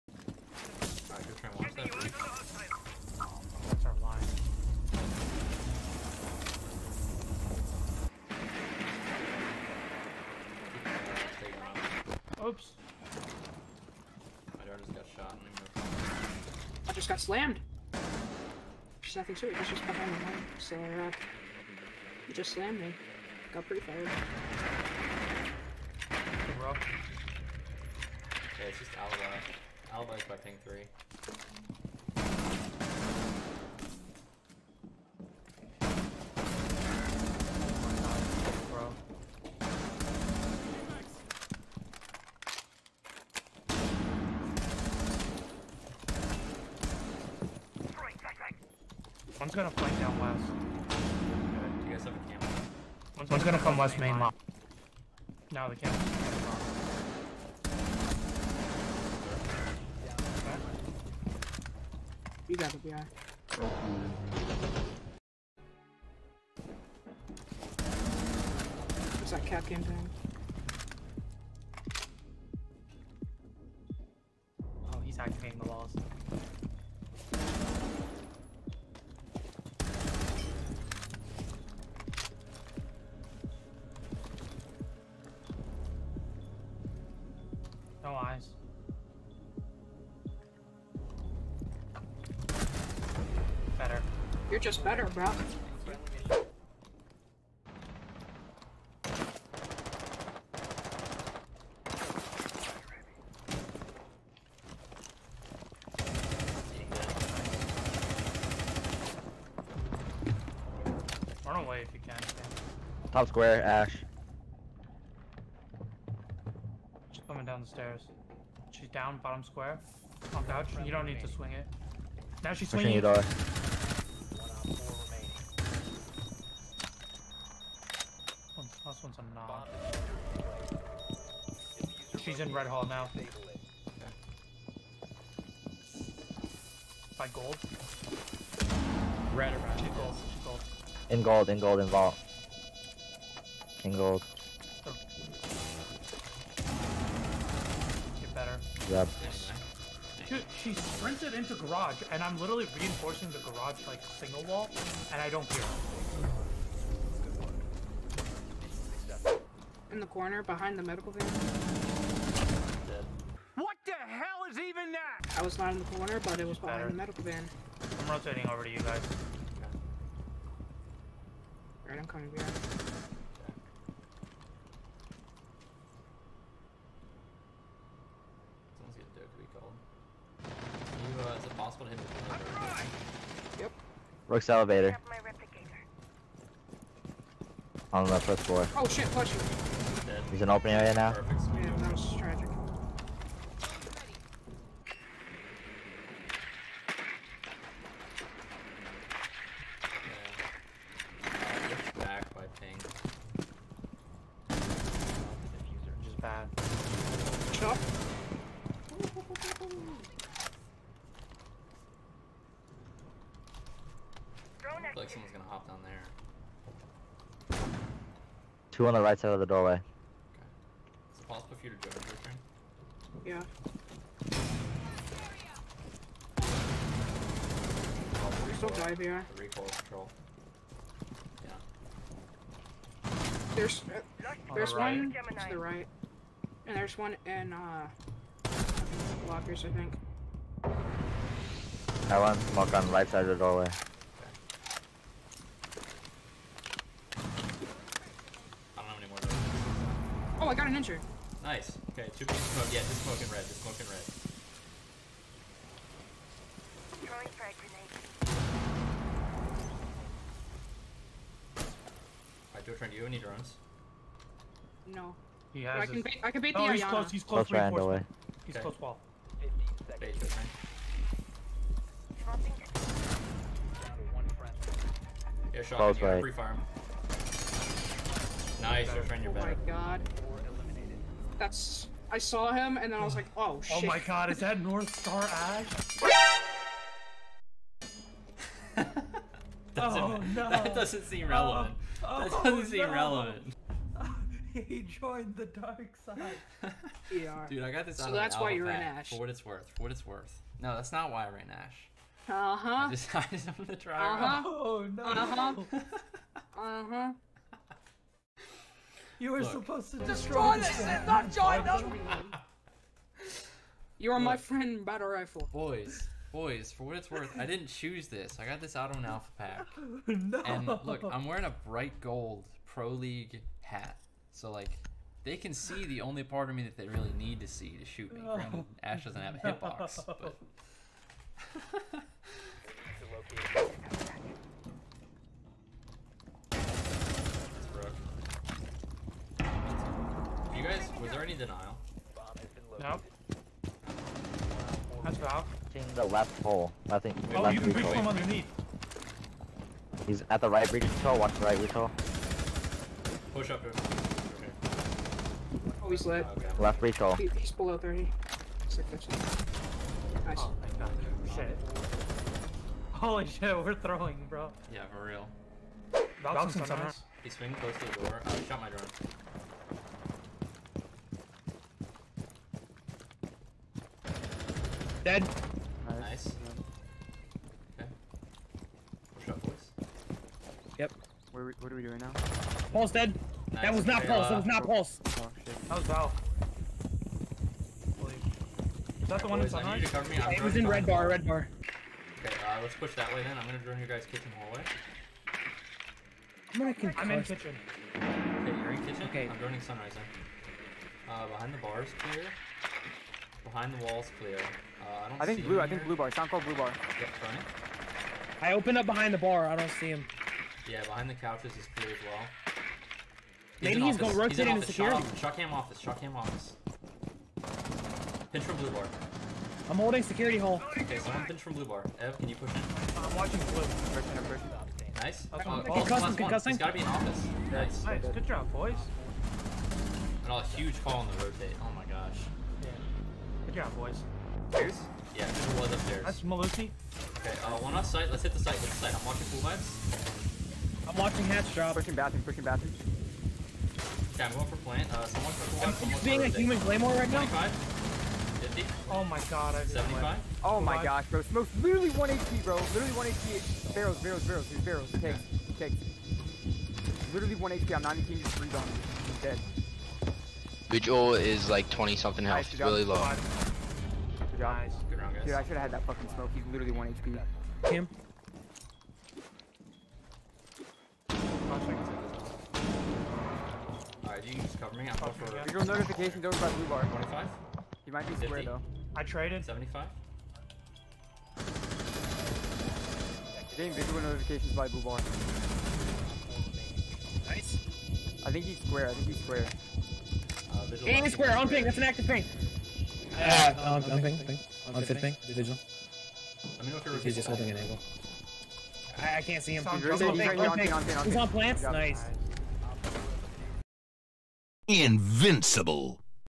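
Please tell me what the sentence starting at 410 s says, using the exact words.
Yeah, behind the couches is clear as well.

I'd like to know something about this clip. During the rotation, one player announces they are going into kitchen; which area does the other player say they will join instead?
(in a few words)
sunrise.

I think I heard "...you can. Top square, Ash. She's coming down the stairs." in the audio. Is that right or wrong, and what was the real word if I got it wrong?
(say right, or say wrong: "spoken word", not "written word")
right.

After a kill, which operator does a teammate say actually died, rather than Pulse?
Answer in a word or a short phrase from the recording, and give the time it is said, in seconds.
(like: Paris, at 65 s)
Val, at 385 s.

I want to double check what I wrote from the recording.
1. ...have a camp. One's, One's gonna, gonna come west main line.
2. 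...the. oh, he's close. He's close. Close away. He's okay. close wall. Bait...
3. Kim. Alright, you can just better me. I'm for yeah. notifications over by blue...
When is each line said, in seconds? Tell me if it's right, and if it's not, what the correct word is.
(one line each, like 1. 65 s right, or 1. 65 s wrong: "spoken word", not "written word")
1. 52 s right
2. 266 s right
3. 467 s wrong: "cover", not "better".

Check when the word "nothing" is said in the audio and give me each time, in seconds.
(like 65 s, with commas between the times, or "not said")
19 s, 346 s.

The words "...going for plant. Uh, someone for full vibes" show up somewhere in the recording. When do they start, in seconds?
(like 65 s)
444 s.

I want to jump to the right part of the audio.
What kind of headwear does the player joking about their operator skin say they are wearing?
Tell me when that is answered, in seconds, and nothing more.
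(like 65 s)
321 s.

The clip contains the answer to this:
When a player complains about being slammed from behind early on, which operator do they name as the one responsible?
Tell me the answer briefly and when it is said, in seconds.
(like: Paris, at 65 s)
Alba, at 26 s.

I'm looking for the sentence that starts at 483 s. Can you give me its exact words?
Getting visual notifications by blue bar.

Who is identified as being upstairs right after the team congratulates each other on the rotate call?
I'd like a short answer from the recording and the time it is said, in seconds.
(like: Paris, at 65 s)
Melusi, at 436 s.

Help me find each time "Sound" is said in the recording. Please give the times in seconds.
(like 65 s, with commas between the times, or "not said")
406 s.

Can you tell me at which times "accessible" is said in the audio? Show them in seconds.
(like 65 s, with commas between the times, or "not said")
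not said.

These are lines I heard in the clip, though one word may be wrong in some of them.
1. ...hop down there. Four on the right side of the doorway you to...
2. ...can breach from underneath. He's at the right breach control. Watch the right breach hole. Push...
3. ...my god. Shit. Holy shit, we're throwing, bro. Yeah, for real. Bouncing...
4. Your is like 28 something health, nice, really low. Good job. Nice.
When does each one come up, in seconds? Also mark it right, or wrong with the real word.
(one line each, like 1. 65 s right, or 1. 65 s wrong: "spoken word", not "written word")
1. 215 s wrong: "Two", not "Four"
2. 347 s right
3. 360 s right
4. 460 s wrong: "20", not "28".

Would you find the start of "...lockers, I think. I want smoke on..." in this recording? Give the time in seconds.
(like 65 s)
239 s.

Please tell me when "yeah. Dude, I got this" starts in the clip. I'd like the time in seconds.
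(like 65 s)
297 s.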